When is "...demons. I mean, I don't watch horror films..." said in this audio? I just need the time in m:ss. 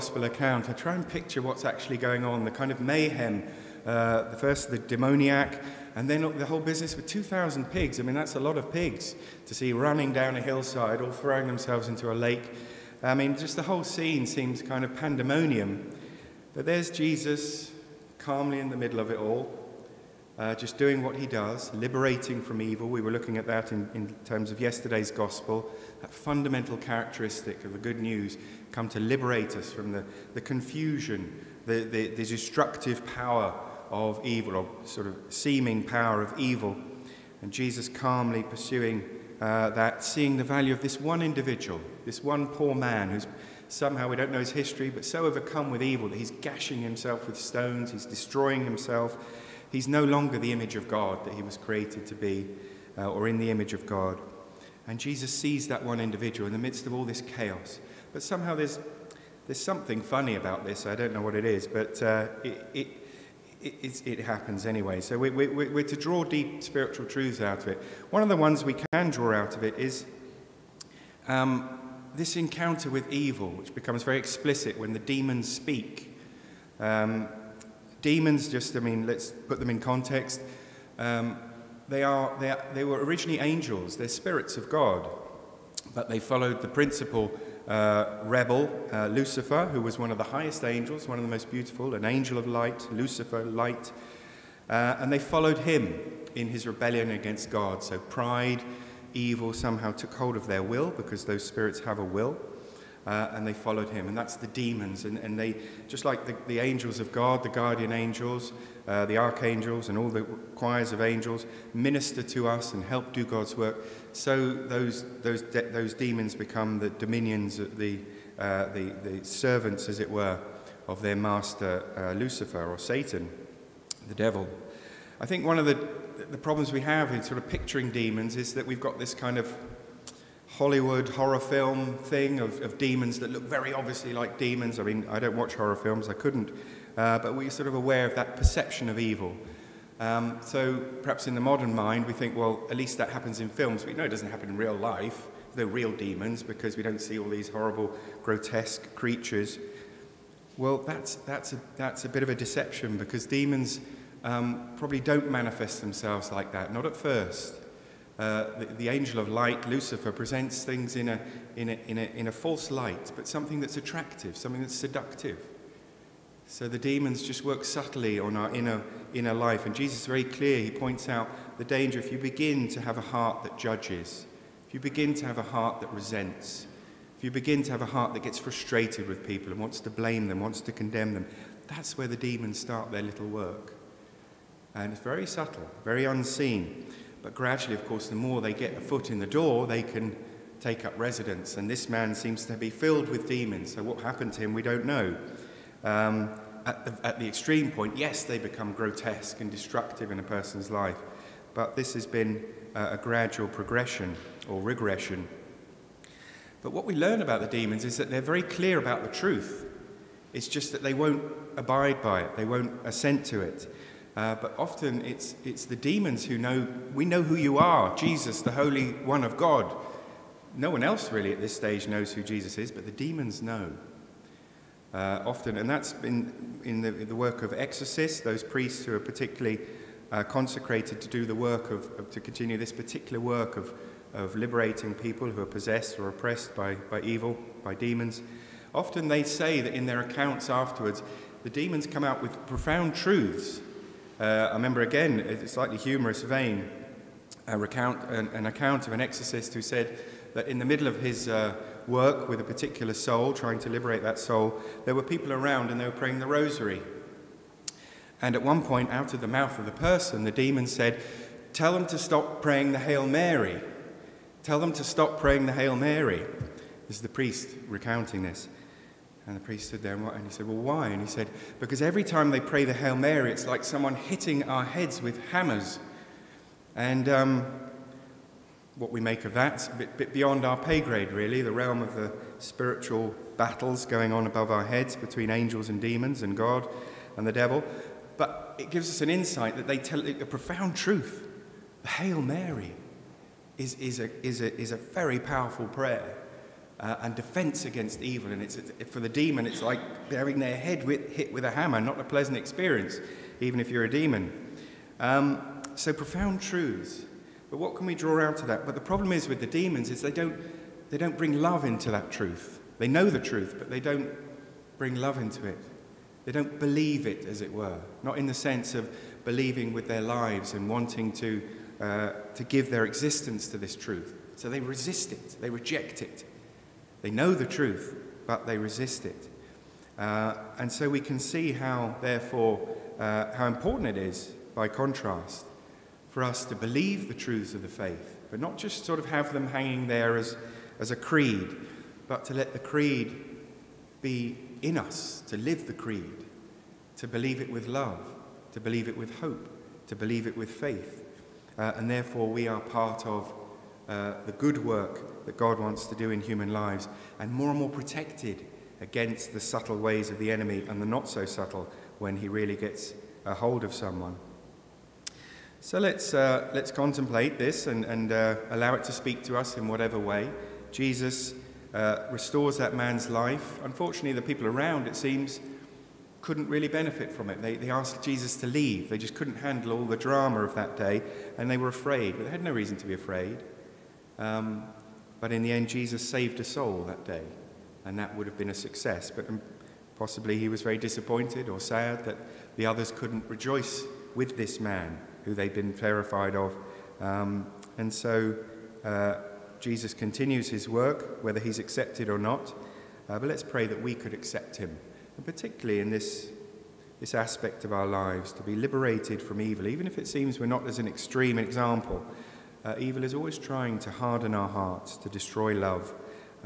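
2:14.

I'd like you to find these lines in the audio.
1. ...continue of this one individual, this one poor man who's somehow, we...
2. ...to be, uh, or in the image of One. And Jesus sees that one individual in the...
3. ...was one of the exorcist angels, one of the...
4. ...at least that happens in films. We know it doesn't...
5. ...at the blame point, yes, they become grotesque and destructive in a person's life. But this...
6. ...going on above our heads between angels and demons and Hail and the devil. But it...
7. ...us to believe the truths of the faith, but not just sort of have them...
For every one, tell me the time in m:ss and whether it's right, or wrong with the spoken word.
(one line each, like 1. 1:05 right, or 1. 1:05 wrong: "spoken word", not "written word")
1. 0:40 wrong: "value", not "continue"
2. 0:52 wrong: "God", not "One"
3. 1:29 wrong: "highest", not "exorcist"
4. 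2:22 right
5. 3:17 wrong: "extreme", not "blame"
6. 4:43 wrong: "God", not "Hail"
7. 5:36 right.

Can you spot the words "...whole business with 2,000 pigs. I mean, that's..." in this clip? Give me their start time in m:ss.
0:06.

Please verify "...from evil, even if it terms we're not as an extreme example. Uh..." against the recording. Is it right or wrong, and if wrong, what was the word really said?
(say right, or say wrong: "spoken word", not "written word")
wrong: "seems", not "terms".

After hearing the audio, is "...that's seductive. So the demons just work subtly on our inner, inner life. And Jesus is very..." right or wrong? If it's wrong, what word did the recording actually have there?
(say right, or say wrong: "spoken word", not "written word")
right.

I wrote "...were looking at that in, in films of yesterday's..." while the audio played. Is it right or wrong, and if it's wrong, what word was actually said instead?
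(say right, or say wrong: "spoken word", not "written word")
wrong: "terms", not "films".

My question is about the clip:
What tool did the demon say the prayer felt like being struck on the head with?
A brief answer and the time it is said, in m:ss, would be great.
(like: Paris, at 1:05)
hammers, at 4:35.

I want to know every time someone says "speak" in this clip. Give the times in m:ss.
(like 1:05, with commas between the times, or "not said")
1:15, 6:08.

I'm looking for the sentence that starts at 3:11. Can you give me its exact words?
And this man seems to be filled with demons.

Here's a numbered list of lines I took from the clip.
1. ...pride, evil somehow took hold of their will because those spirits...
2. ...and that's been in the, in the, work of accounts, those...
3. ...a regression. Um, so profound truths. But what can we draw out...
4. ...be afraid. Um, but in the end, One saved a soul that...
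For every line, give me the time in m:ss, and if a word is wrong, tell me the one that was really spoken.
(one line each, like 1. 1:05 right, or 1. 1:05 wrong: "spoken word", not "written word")
1. 1:37 right
2. 3:45 wrong: "exorcists", not "accounts"
3. 5:03 wrong: "demon", not "regression"
4. 6:22 wrong: "Jesus", not "One".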